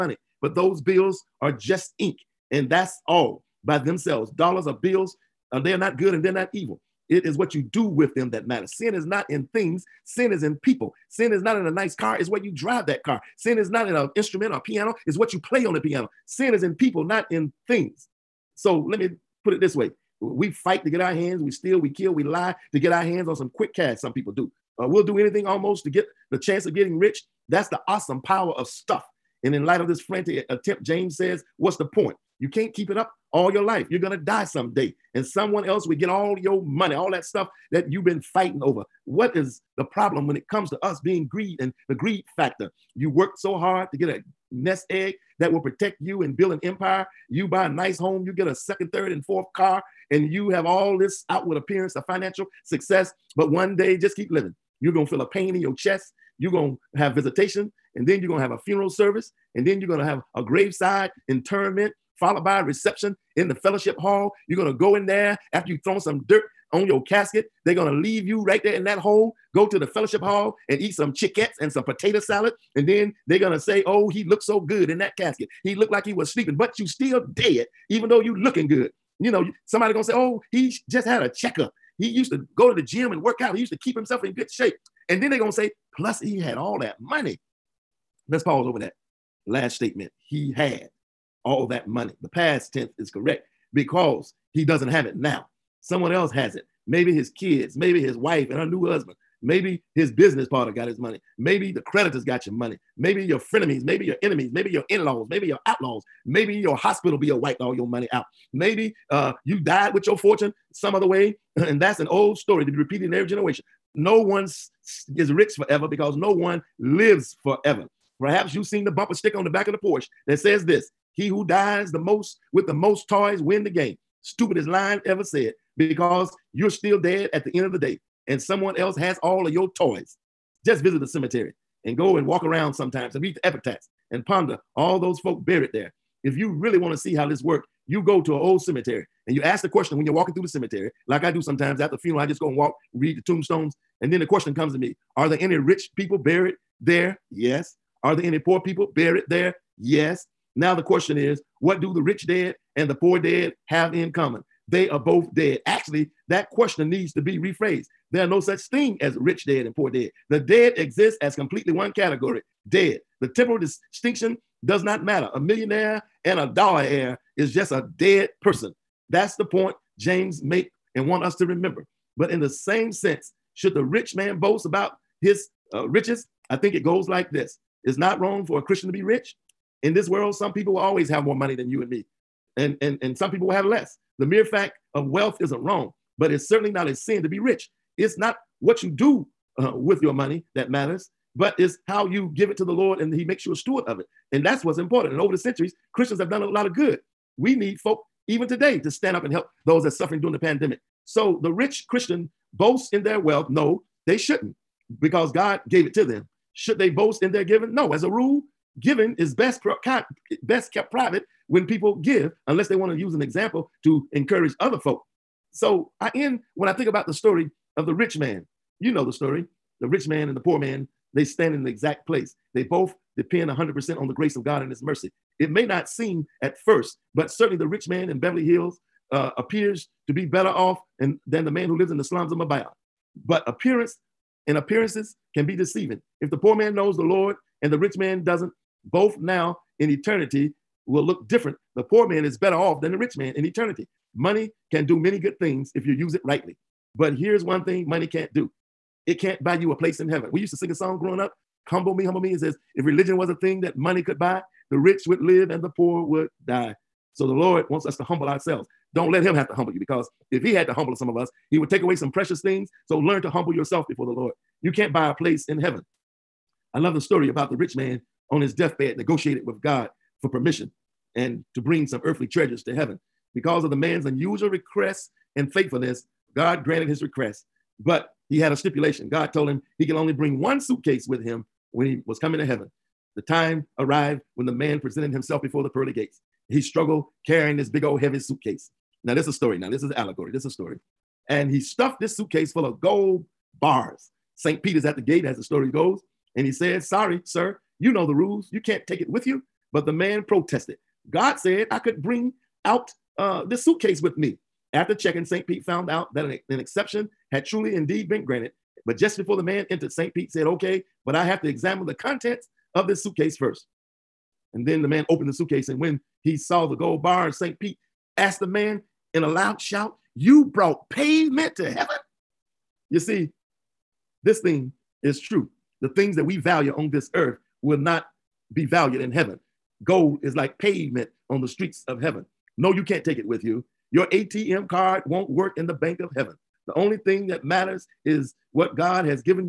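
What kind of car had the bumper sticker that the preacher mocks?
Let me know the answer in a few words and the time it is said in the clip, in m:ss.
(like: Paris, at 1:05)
Porsche, at 1:59.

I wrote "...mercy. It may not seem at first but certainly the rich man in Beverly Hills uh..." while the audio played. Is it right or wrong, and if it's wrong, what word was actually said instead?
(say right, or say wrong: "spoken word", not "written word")
right.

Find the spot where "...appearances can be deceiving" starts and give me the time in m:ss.
3:54.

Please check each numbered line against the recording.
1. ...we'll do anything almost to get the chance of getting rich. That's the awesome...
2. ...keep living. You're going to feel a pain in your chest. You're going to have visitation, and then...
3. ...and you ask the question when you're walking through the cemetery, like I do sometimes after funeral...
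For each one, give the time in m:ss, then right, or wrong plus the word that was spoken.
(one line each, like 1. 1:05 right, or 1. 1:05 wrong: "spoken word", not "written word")
1. 0:24 right
2. 0:54 right
3. 2:19 right.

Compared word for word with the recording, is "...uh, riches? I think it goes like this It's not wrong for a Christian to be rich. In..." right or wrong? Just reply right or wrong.
right.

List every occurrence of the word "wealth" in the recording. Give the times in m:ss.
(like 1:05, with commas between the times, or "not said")
3:05, 3:23.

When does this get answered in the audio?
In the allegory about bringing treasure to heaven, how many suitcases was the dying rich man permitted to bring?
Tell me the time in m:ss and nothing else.
4:40.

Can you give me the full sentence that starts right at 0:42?
You worked so hard to get a nest egg that will protect you and build an empire.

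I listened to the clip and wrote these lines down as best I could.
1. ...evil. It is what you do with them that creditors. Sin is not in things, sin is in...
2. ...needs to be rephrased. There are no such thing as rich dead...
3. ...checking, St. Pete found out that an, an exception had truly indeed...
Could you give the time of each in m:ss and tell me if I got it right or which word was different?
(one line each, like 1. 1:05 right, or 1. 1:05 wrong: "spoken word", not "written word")
1. 0:06 wrong: "matters", not "creditors"
2. 2:36 right
3. 5:04 right.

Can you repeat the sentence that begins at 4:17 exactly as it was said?
So the Lord wants us to humble ourselves.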